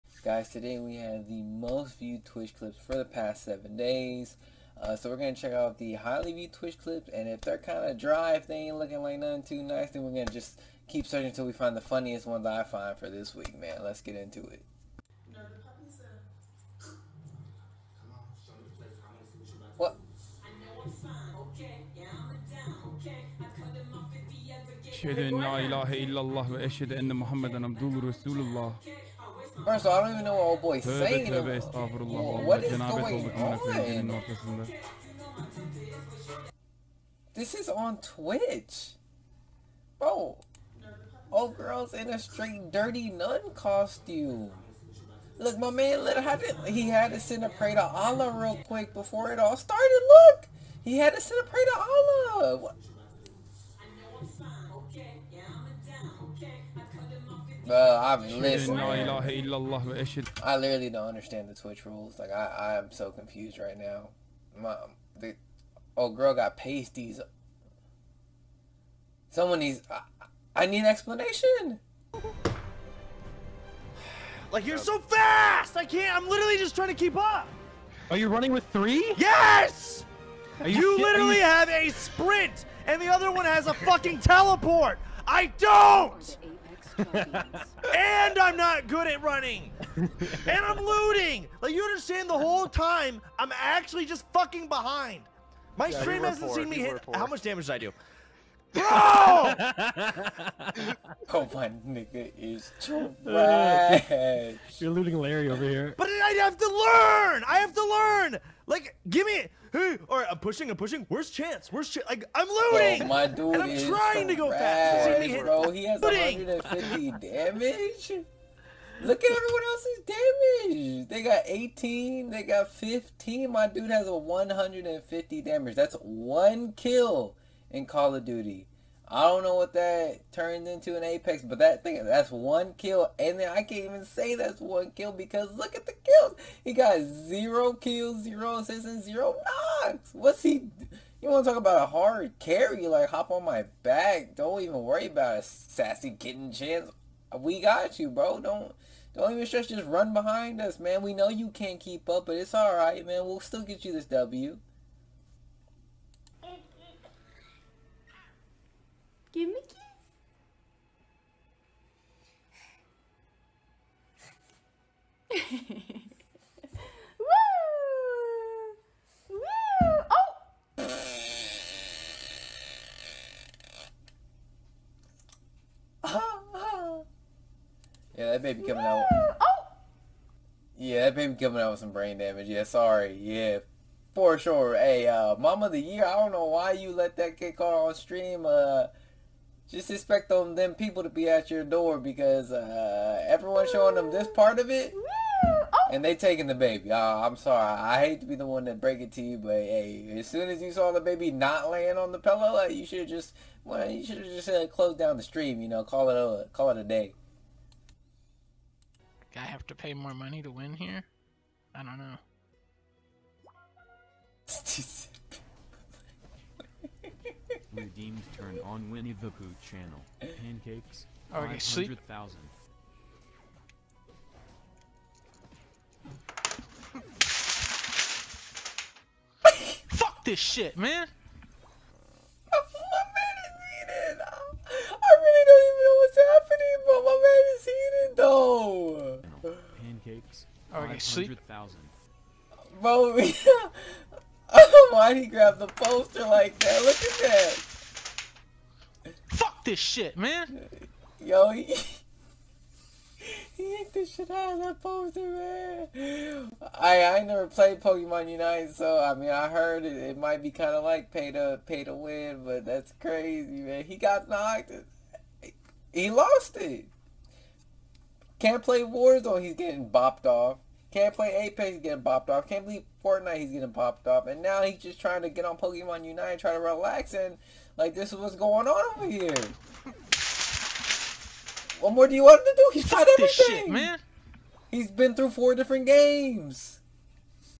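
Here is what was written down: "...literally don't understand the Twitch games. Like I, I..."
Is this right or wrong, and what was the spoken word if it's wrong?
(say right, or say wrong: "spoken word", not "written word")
wrong: "rules", not "games".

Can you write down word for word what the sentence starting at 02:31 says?
We know you can't keep up, but it's all right, man.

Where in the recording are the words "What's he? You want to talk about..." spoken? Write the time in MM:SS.
02:20.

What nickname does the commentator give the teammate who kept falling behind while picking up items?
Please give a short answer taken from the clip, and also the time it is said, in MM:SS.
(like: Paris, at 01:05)
Looting Larry, at 01:44.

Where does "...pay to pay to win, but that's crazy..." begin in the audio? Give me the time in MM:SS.
04:21.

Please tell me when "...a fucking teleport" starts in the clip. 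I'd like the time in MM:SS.
01:23.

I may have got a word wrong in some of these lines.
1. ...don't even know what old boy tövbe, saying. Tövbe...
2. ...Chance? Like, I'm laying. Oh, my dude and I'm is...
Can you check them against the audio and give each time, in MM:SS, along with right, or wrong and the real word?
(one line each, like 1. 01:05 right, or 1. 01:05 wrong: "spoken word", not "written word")
1. 00:30 right
2. 01:51 wrong: "looting", not "laying".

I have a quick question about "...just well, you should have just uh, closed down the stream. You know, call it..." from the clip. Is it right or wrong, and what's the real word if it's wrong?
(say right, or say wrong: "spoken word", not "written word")
right.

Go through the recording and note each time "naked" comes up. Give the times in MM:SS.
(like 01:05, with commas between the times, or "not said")
not said.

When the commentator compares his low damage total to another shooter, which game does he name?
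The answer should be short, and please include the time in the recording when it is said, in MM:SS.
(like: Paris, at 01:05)
Call of Duty, at 02:07.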